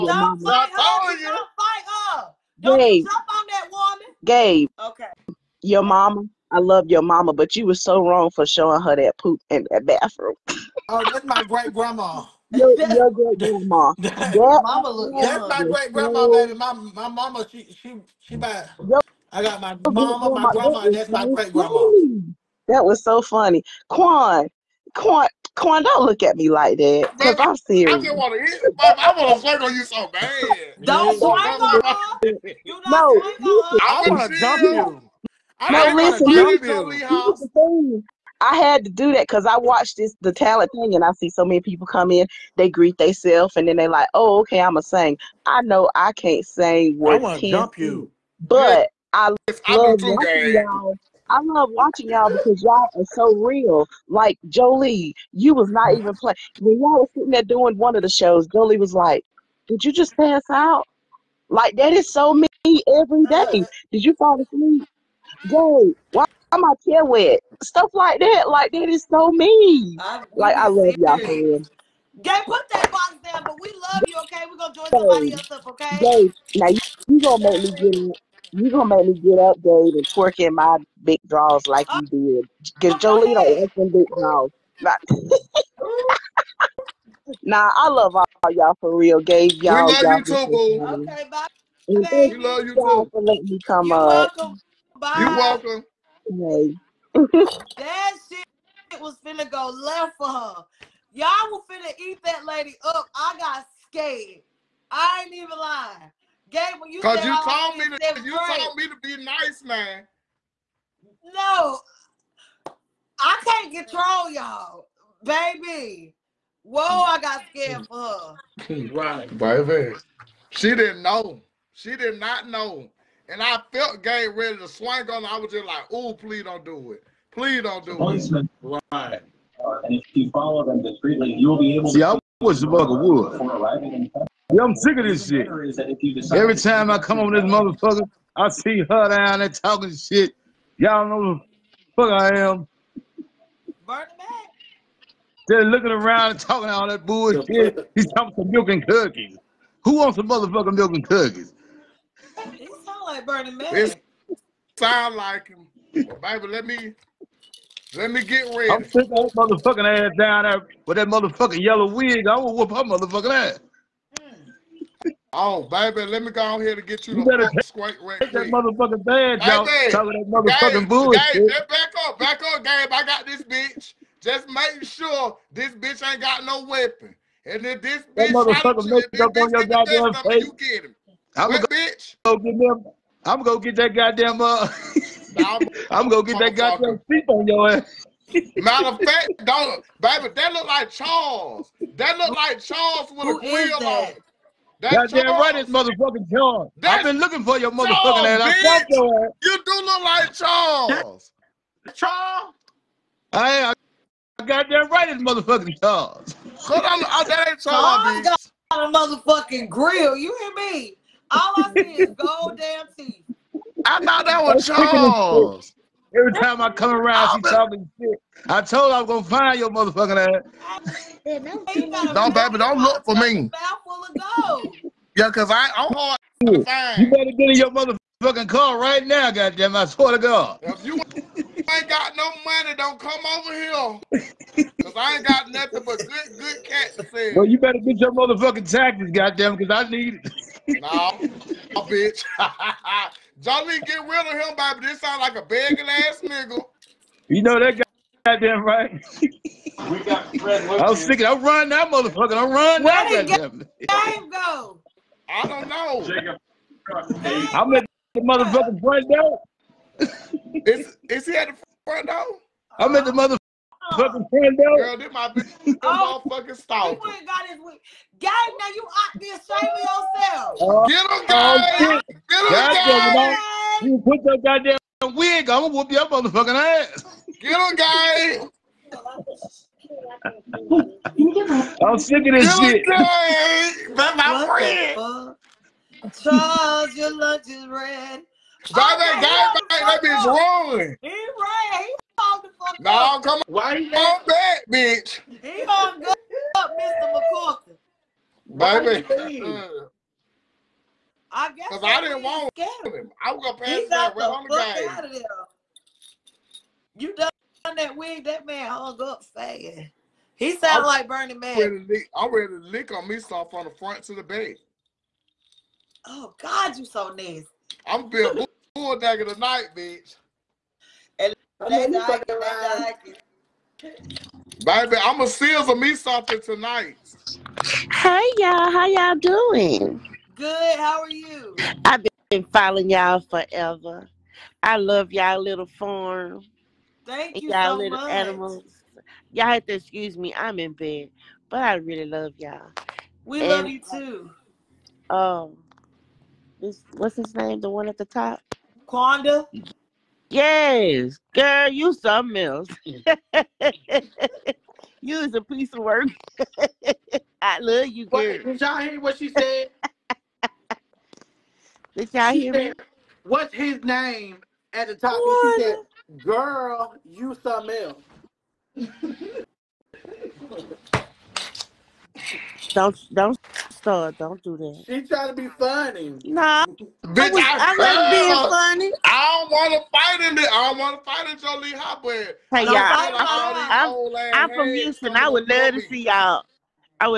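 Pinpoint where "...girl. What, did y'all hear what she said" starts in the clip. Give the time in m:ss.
5:58.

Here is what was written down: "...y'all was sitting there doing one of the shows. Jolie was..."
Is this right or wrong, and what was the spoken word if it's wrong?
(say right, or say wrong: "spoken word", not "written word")
right.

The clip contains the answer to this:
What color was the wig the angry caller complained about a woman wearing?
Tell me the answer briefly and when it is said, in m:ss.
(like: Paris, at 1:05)
Yellow, at 2:41.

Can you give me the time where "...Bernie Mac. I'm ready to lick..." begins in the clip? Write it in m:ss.
5:11.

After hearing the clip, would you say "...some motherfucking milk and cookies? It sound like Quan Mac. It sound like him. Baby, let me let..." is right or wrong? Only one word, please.
wrong.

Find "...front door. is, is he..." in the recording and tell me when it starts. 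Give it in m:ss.
4:18.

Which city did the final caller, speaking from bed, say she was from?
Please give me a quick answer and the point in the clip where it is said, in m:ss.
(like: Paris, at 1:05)
Houston, at 6:24.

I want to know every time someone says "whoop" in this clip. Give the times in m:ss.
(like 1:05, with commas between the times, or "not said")
2:42, 4:35.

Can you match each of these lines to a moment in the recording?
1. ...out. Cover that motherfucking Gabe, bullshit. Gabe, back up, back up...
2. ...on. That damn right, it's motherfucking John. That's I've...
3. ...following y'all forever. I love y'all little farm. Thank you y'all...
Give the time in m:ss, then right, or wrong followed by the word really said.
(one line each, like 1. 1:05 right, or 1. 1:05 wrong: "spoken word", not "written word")
1. 2:49 right
2. 3:13 right
3. 5:32 right.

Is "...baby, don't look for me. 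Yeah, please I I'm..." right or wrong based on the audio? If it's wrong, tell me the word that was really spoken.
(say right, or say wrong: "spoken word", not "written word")
wrong: "cause", not "please".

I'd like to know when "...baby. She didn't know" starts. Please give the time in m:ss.
1:59.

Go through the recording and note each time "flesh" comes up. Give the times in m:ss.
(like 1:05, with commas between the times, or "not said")
not said.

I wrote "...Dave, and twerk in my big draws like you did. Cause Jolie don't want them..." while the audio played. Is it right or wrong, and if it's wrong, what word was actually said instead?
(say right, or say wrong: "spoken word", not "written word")
right.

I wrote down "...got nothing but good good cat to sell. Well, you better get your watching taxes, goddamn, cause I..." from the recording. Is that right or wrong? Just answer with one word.
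wrong.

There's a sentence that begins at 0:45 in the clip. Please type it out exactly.
I know I can't sing what I want to jump you, but yeah.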